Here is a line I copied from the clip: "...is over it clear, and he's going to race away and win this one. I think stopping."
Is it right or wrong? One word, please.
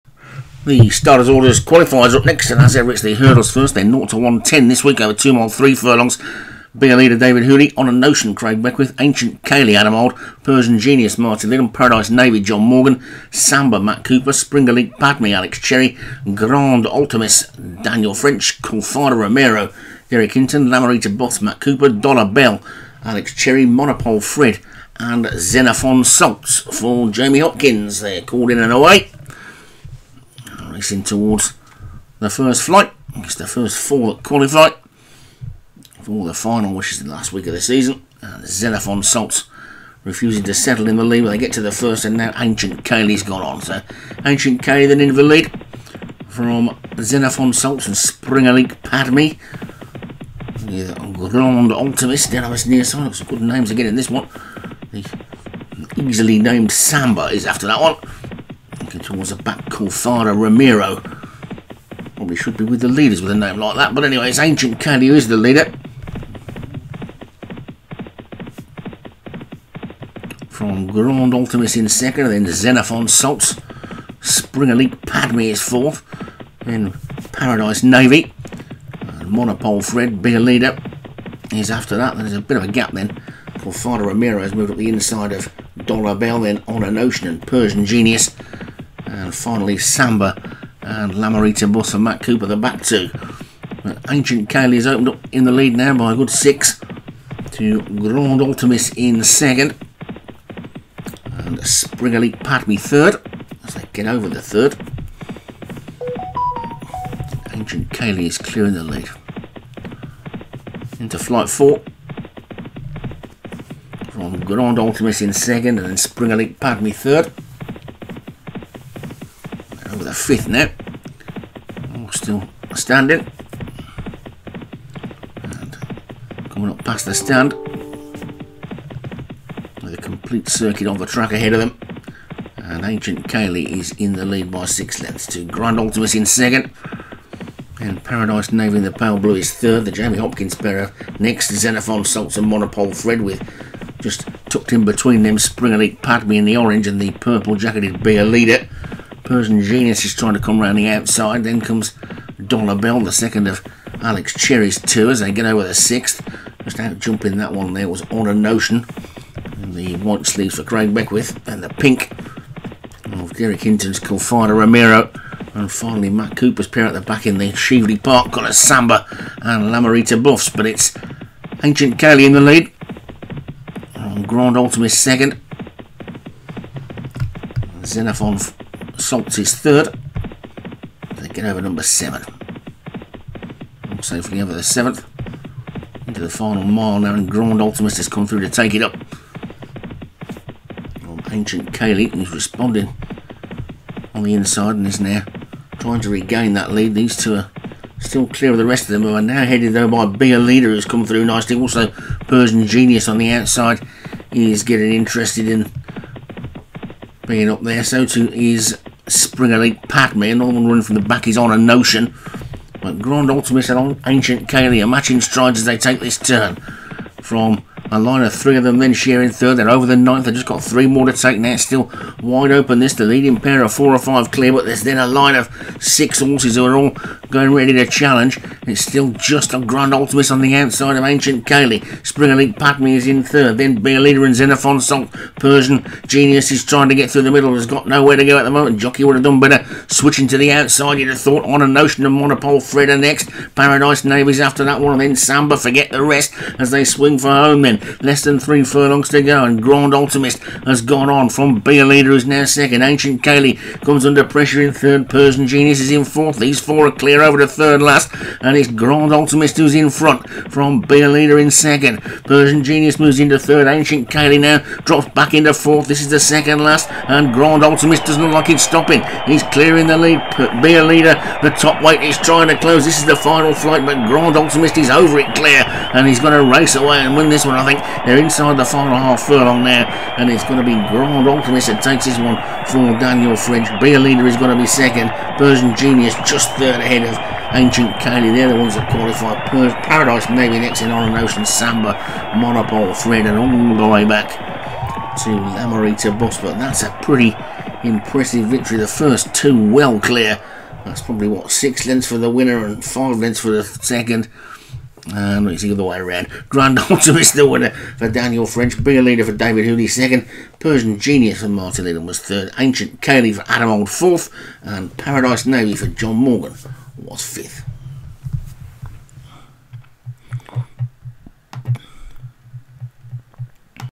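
wrong.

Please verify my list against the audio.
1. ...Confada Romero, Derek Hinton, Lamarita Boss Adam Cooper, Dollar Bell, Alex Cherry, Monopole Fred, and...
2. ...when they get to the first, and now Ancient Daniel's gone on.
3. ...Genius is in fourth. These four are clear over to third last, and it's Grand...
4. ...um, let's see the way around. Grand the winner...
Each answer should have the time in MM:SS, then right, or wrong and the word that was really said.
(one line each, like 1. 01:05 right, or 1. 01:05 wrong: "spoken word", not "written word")
1. 00:18 wrong: "Matt", not "Adam"
2. 00:41 wrong: "Kaylee", not "Daniel"
3. 04:15 right
4. 05:05 right.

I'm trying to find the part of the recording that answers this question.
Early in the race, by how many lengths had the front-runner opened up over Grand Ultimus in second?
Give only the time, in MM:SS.
01:36.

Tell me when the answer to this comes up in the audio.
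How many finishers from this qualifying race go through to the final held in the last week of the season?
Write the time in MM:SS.
00:33.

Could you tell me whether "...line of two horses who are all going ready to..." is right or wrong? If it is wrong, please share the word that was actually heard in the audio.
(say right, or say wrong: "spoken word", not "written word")
wrong: "six", not "two".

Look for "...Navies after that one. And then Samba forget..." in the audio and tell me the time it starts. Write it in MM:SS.
04:04.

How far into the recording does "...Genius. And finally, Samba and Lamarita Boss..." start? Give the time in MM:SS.
01:27.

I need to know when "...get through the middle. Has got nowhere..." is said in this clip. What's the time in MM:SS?
03:56.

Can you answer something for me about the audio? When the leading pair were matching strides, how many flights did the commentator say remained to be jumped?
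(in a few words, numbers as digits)
3.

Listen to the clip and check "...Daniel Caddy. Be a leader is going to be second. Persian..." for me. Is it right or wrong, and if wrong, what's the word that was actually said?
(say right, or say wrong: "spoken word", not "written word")
wrong: "French", not "Caddy".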